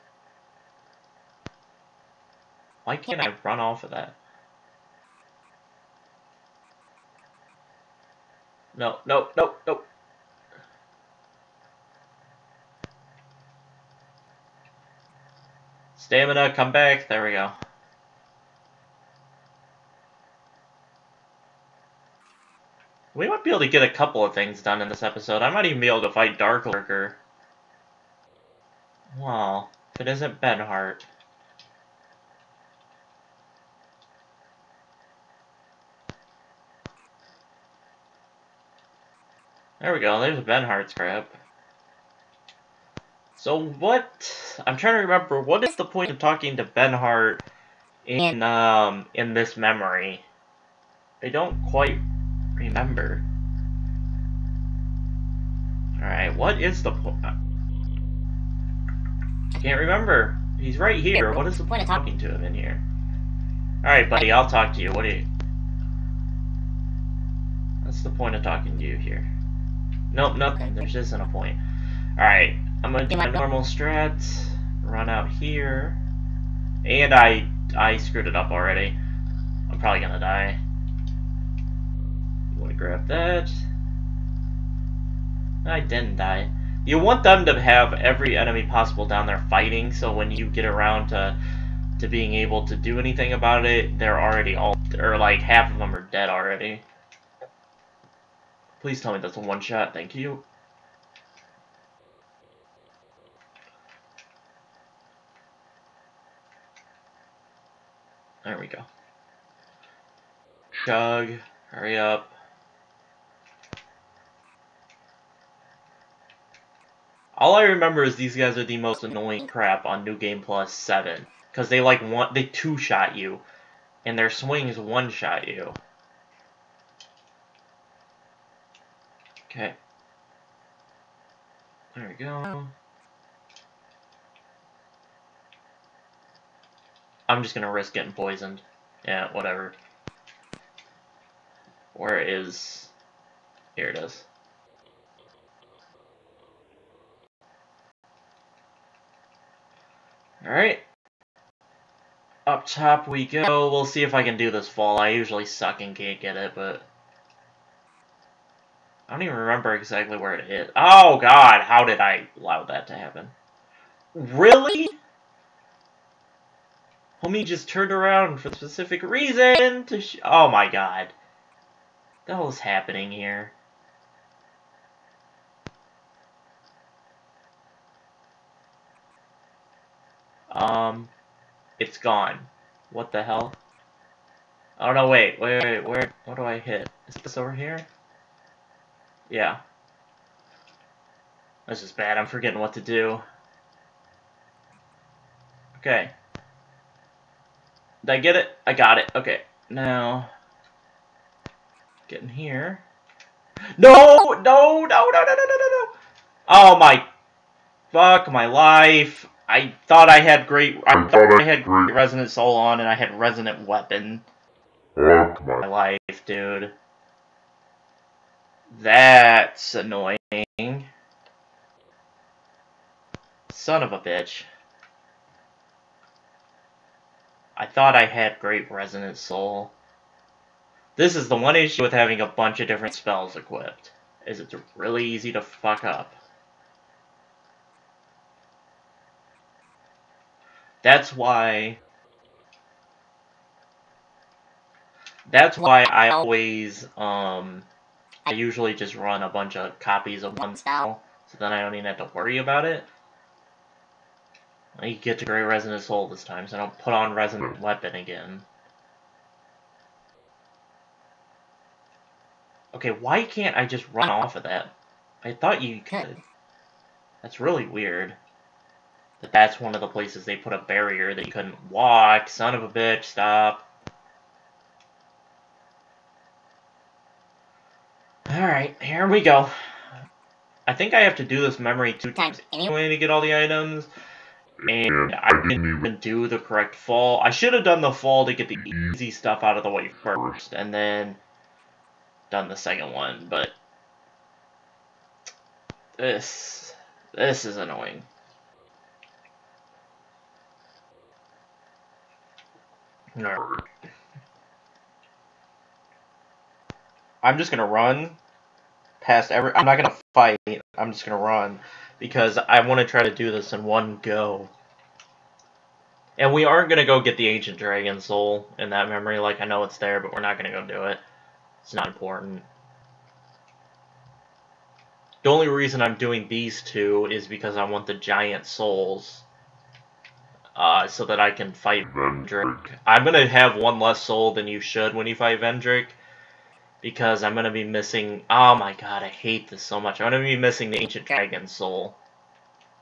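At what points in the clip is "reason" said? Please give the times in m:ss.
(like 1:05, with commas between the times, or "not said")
2:49, 5:25.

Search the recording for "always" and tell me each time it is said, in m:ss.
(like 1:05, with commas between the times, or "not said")
4:06.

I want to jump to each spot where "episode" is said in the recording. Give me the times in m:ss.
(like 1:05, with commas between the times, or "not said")
0:25.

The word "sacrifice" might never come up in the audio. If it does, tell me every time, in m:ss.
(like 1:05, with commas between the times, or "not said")
not said.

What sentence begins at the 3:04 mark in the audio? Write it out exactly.
Oh no, wait, wait, wait, where, what do I hit?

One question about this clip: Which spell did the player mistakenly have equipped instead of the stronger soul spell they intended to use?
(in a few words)
Resonant Weapon.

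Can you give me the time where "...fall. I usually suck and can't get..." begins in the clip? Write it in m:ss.
2:34.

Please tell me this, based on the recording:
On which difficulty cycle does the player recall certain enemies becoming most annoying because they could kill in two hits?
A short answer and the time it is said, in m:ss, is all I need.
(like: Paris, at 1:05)
New Game Plus 7, at 2:00.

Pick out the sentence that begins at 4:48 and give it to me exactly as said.
easy stuff out of the way first, and then done the second one, but this, this is annoying.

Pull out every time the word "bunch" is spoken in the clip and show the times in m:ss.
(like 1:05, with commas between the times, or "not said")
3:52, 4:09.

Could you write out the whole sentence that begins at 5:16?
And we aren't gonna go get the ancient dragon soul in that memory.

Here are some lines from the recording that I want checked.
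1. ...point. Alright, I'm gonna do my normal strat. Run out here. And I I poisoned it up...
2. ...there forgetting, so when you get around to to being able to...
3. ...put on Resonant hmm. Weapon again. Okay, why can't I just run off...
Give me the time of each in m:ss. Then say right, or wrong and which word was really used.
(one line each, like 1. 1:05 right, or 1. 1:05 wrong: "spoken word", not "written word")
1. 1:11 wrong: "screwed", not "poisoned"
2. 1:29 wrong: "fighting", not "forgetting"
3. 4:16 right.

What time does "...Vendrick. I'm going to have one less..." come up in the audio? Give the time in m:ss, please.
5:31.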